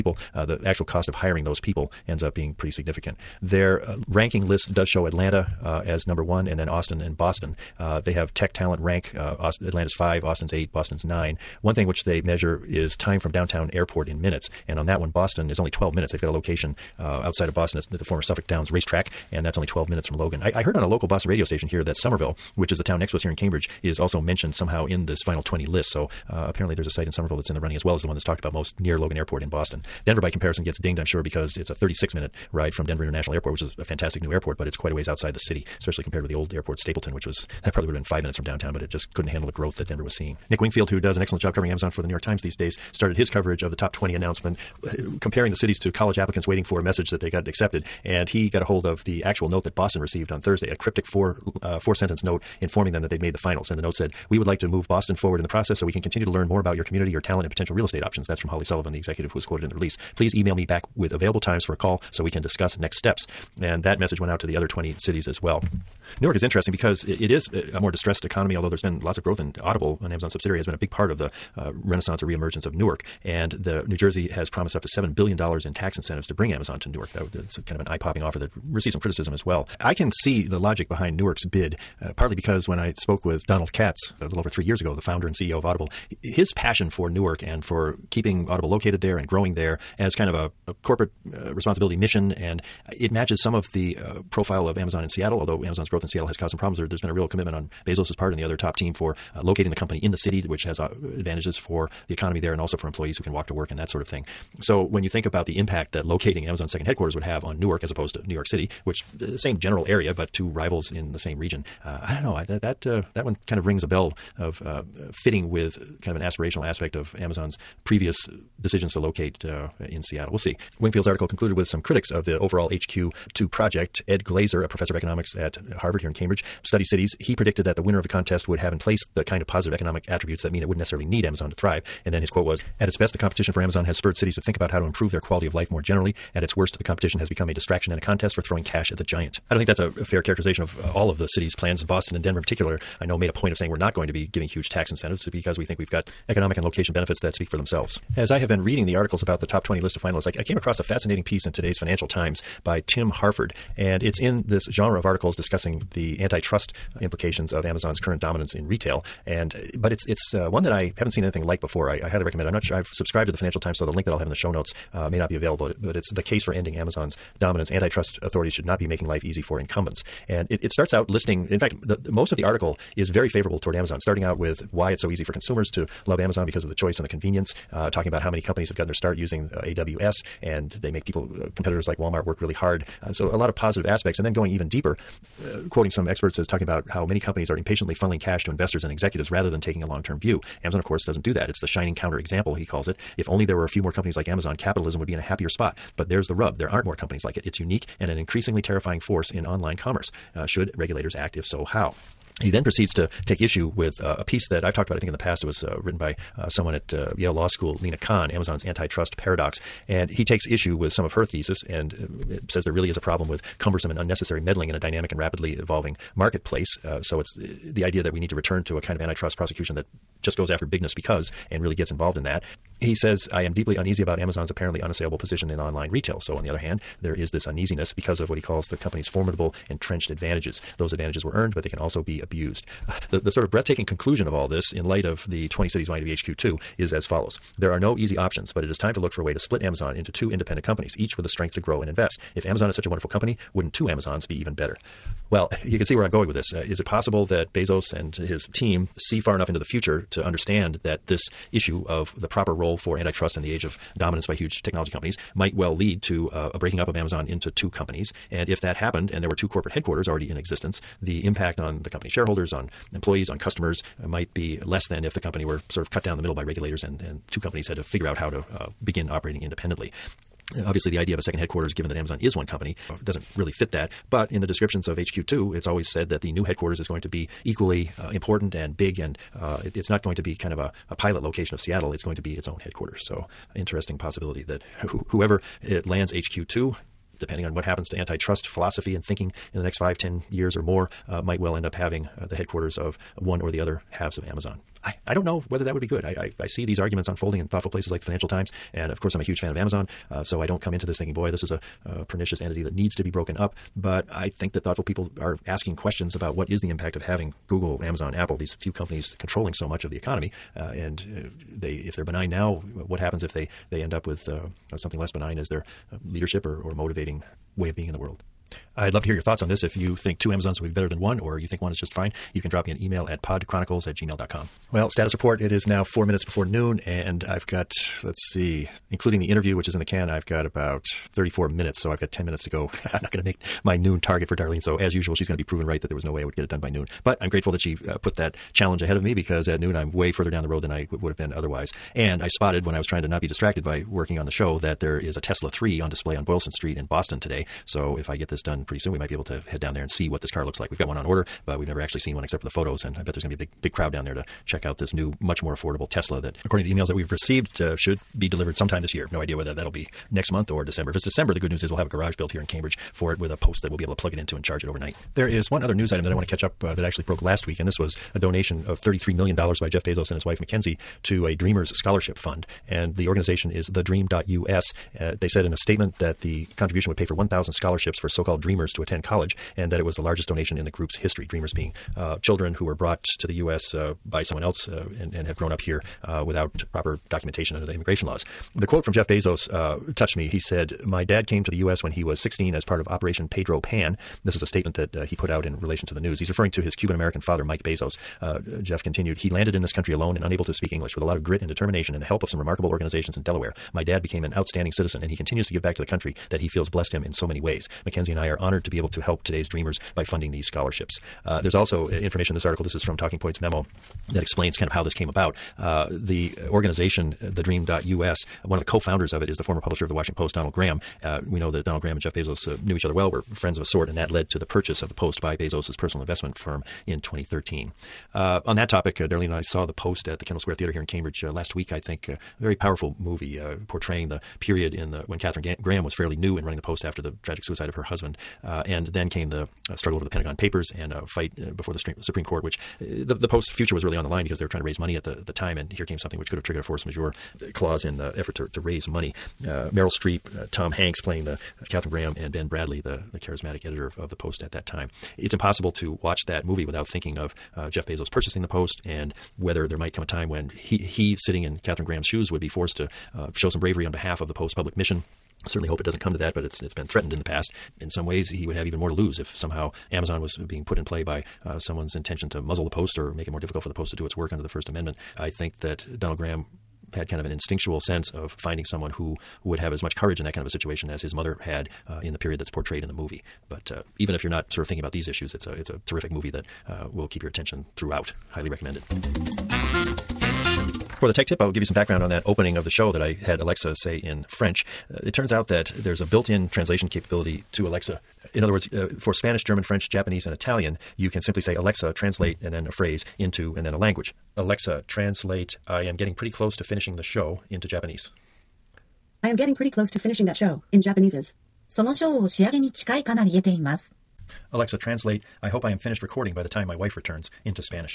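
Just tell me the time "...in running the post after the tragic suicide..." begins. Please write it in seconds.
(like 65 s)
436 s.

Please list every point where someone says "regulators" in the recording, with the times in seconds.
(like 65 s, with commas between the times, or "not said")
200 s, 266 s.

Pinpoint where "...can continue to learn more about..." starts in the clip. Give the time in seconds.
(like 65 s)
55 s.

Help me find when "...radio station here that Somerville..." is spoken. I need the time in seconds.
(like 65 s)
21 s.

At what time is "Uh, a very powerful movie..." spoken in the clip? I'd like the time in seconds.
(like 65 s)
432 s.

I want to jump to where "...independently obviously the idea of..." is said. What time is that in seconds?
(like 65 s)
269 s.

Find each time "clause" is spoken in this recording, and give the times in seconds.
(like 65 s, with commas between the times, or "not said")
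447 s.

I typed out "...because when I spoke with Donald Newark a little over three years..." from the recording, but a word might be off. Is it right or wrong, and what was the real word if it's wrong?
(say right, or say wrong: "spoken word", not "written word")
wrong: "Katz", not "Newark".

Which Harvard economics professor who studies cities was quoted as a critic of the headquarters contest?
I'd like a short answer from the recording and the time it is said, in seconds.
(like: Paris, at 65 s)
Ed Glaeser, at 124 s.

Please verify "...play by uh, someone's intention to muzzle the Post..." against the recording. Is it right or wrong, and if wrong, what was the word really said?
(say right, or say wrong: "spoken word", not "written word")
right.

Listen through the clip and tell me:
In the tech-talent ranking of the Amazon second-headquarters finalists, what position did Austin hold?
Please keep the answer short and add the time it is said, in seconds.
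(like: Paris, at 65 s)
8, at 10 s.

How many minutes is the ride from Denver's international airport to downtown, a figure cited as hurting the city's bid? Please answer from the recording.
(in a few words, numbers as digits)
36.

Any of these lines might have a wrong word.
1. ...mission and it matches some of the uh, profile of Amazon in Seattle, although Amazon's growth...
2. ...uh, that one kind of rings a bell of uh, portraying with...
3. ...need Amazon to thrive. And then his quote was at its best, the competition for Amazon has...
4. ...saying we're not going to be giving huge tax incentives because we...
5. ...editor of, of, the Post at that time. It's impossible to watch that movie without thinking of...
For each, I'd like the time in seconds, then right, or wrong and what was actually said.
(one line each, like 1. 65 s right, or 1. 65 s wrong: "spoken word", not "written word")
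1. 91 s right
2. 112 s wrong: "fitting", not "portraying"
3. 131 s right
4. 143 s right
5. 453 s right.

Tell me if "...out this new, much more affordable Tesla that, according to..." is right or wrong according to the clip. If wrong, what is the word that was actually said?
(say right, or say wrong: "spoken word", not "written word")
right.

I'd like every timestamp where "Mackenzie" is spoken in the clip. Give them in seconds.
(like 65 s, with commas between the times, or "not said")
370 s, 407 s.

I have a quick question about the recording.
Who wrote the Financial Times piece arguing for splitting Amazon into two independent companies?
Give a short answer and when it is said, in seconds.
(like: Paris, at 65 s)
Tim Harford, at 152 s.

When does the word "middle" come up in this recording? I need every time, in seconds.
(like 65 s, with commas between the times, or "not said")
266 s.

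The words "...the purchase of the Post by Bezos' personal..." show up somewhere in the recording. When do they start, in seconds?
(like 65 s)
424 s.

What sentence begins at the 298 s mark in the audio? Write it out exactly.
And of course, I'm a huge fan of Amazon.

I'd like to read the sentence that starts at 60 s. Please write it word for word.
Please email me back with available times for a call so we can discuss next steps.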